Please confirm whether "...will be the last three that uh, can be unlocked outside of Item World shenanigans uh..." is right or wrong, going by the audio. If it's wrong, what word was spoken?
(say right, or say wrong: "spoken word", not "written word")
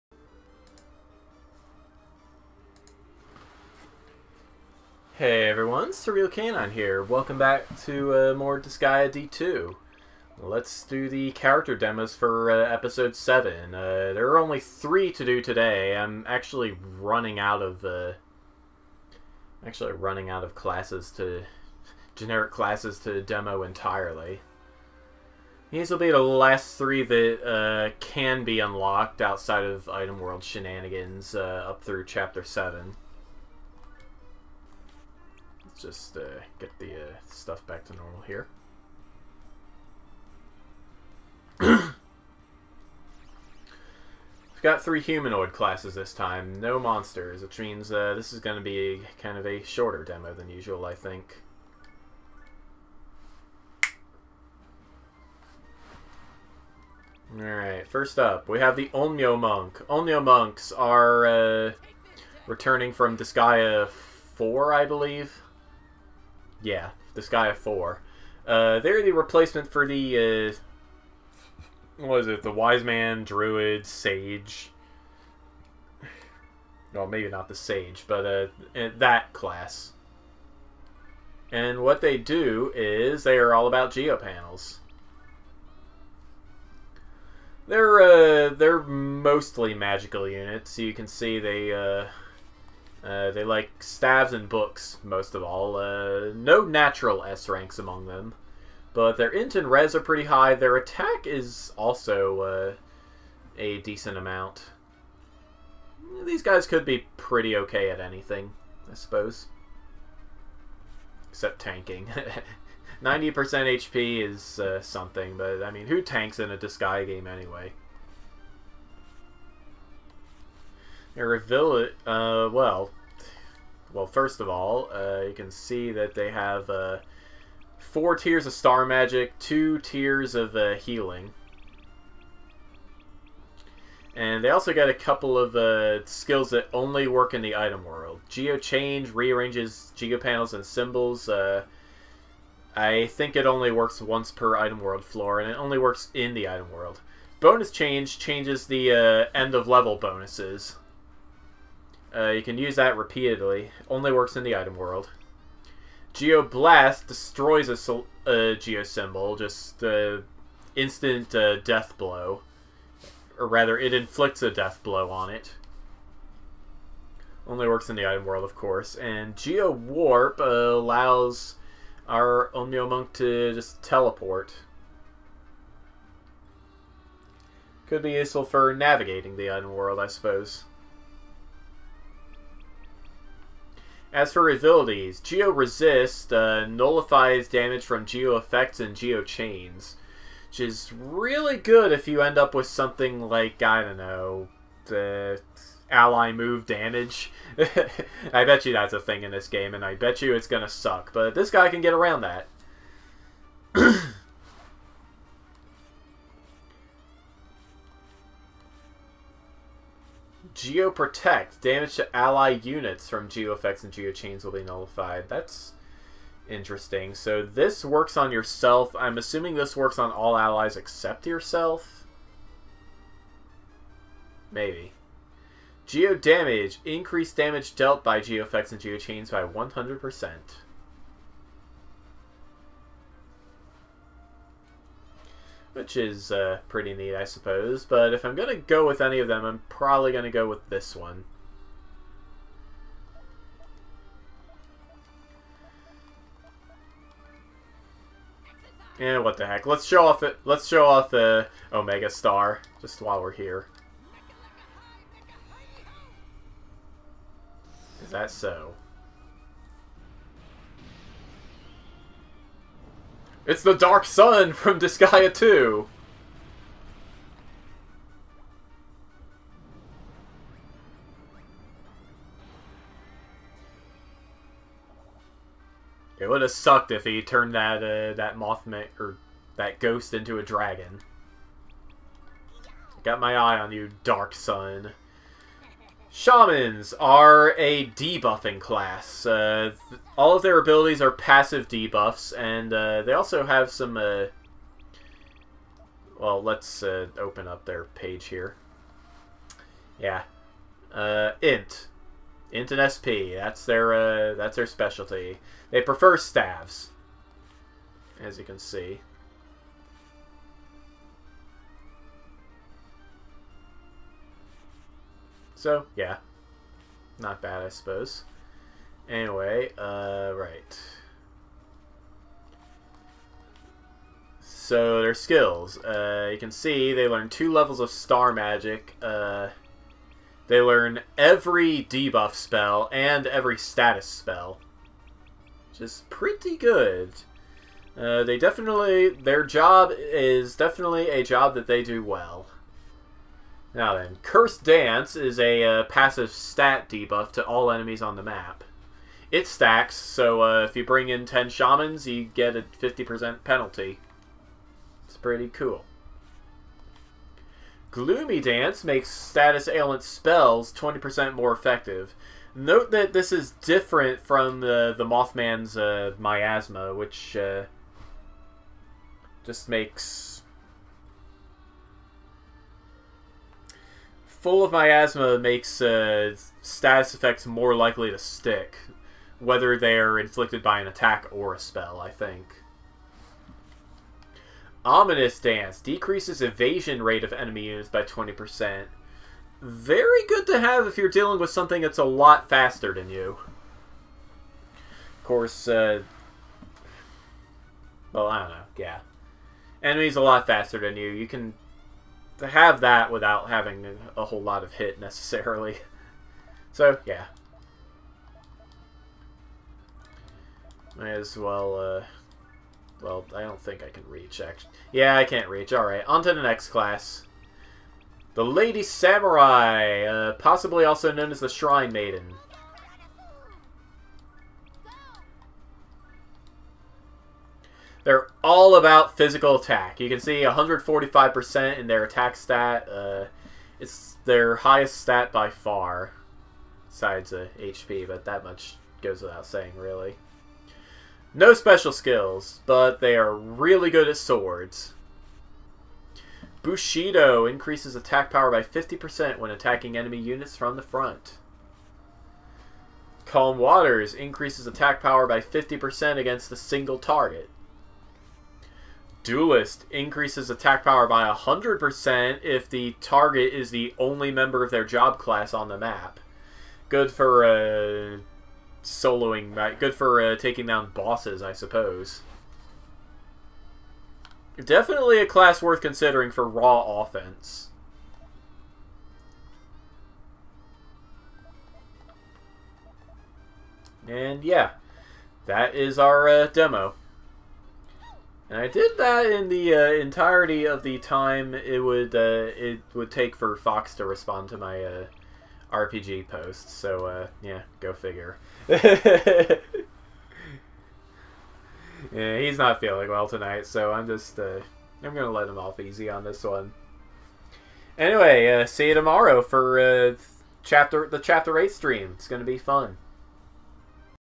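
right.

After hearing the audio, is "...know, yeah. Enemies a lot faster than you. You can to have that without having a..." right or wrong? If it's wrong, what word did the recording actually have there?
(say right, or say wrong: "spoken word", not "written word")
right.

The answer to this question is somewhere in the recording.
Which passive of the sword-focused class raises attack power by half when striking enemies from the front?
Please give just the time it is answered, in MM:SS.
07:26.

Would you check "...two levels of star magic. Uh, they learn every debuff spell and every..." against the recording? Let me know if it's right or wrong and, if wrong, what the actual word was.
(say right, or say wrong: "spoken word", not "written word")
right.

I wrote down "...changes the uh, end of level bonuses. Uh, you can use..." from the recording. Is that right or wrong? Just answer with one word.
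right.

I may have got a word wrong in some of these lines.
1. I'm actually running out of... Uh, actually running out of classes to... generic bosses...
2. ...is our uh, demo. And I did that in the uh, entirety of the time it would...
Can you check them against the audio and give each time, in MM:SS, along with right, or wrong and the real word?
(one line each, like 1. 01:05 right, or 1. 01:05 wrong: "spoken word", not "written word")
1. 00:15 wrong: "classes", not "bosses"
2. 08:05 right.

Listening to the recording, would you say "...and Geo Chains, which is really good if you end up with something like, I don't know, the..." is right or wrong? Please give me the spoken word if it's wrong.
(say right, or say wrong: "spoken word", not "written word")
right.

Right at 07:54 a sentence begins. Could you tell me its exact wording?
Definitely a class worth considering for raw offense.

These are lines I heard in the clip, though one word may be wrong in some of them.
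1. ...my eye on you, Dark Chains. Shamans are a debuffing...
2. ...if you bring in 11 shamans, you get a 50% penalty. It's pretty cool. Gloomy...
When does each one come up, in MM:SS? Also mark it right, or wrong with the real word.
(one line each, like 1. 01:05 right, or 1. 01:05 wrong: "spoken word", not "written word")
1. 04:43 wrong: "Sun", not "Chains"
2. 05:50 wrong: "10", not "11".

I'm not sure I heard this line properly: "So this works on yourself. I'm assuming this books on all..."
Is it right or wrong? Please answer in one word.
wrong.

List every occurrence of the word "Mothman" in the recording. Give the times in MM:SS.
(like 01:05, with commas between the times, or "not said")
04:38, 06:05.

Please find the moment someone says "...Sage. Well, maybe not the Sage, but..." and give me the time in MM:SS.
01:13.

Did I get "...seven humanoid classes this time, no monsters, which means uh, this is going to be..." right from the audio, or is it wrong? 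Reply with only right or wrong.
wrong.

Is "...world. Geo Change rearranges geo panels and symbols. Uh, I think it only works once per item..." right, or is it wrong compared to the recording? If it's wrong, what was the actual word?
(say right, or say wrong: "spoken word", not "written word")
right.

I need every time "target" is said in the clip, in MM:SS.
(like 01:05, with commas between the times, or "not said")
07:36, 07:43.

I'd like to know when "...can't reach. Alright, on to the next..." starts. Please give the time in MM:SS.
06:55.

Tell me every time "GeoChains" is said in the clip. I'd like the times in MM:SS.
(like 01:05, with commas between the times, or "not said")
03:33, 03:48.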